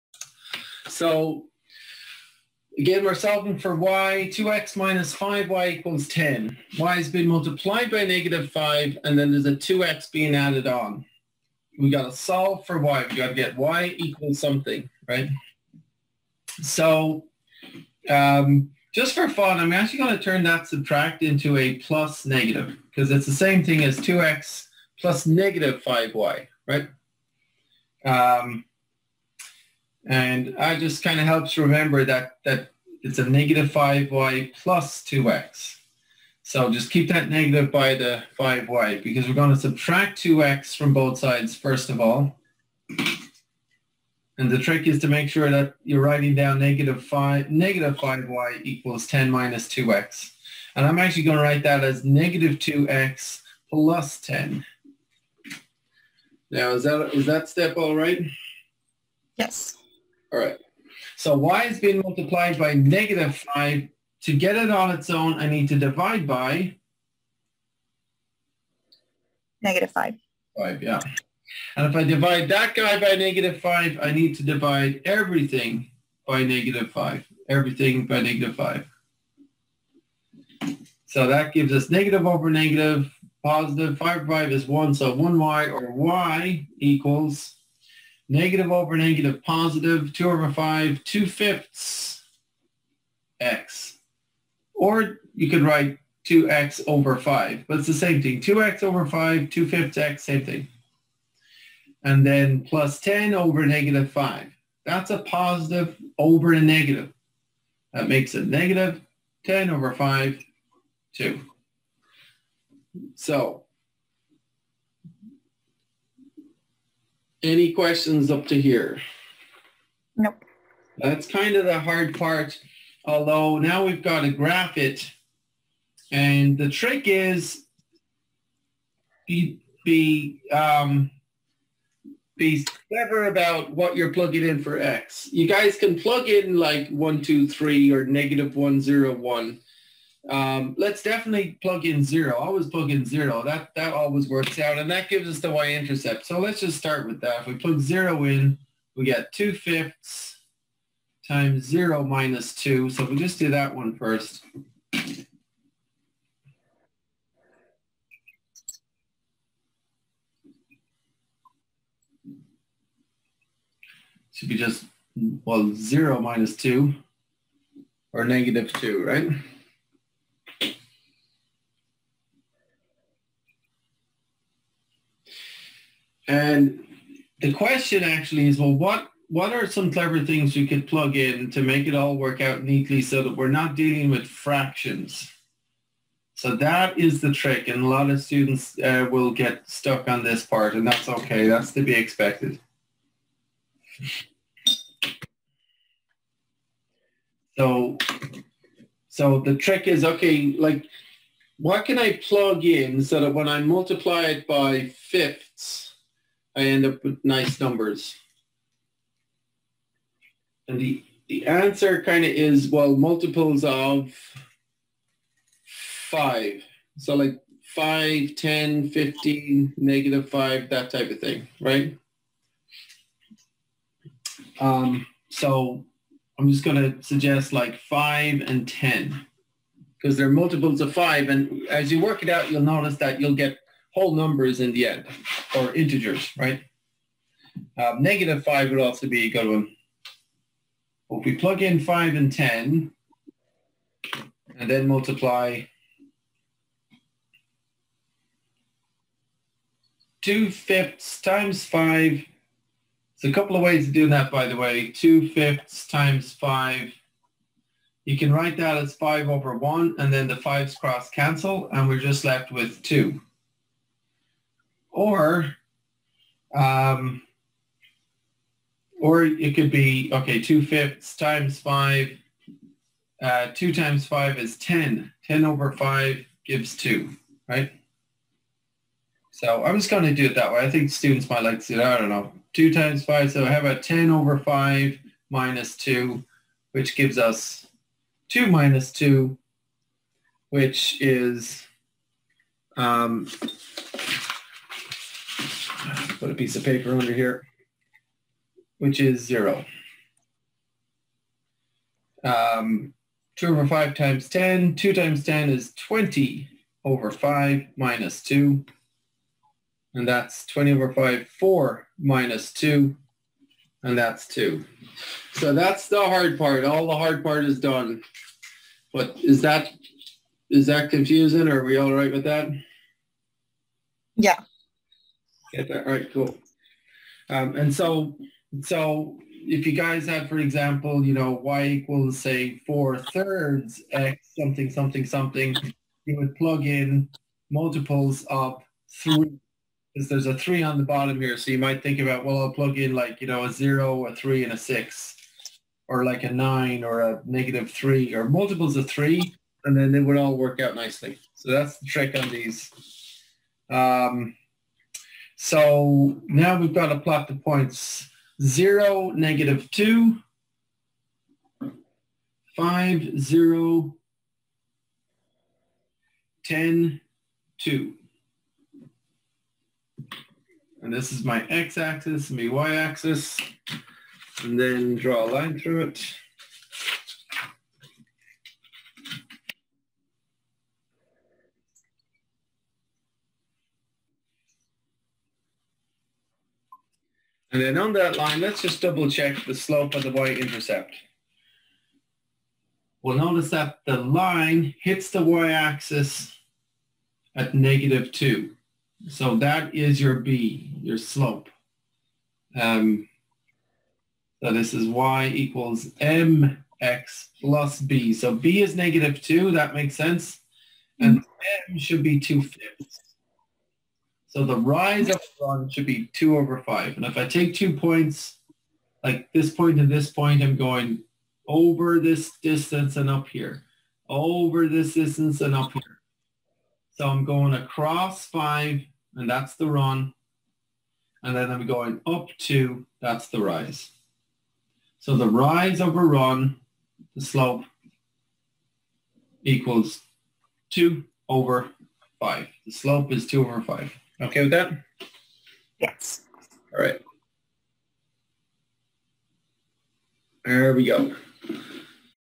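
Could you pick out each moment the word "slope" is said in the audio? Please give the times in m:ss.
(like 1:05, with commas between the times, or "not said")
6:29, 6:40, 7:17, 7:22.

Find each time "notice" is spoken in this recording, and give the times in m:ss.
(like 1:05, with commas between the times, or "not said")
3:52, 6:33.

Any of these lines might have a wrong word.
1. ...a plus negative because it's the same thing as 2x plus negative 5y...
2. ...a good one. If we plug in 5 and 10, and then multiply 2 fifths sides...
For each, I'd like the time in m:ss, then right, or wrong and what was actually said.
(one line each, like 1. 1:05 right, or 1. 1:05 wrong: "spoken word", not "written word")
1. 0:21 right
2. 3:59 wrong: "times", not "sides".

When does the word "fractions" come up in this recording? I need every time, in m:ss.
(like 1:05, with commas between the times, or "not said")
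3:04.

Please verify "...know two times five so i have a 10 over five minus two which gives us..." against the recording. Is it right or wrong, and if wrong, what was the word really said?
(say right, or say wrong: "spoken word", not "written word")
right.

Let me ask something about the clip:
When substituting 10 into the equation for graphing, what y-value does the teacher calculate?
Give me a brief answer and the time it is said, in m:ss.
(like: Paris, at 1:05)
2, at 5:13.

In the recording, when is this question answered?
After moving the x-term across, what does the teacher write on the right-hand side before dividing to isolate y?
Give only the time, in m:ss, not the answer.
0:52.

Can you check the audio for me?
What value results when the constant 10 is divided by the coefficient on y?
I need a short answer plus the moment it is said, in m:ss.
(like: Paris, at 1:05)
-2, at 1:48.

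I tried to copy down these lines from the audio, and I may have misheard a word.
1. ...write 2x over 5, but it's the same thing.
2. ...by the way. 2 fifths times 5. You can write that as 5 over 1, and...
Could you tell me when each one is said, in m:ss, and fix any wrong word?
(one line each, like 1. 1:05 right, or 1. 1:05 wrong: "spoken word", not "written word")
1. 1:35 right
2. 4:14 right.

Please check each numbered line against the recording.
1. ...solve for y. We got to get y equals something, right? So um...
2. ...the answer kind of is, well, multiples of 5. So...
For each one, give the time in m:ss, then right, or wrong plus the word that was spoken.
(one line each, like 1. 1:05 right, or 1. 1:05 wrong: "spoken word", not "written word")
1. 0:12 right
2. 3:31 right.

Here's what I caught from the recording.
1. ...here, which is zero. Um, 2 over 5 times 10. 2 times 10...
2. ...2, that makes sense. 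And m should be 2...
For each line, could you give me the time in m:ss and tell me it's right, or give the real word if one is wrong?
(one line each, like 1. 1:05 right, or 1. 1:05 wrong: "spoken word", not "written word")
1. 4:57 right
2. 6:49 right.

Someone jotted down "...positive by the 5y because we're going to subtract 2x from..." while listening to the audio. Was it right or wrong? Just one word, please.
wrong.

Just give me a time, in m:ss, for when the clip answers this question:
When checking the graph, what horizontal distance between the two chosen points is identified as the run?
7:07.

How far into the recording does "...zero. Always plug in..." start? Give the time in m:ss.
2:22.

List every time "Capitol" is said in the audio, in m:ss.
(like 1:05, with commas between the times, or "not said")
not said.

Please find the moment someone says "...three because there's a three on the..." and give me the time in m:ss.
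5:39.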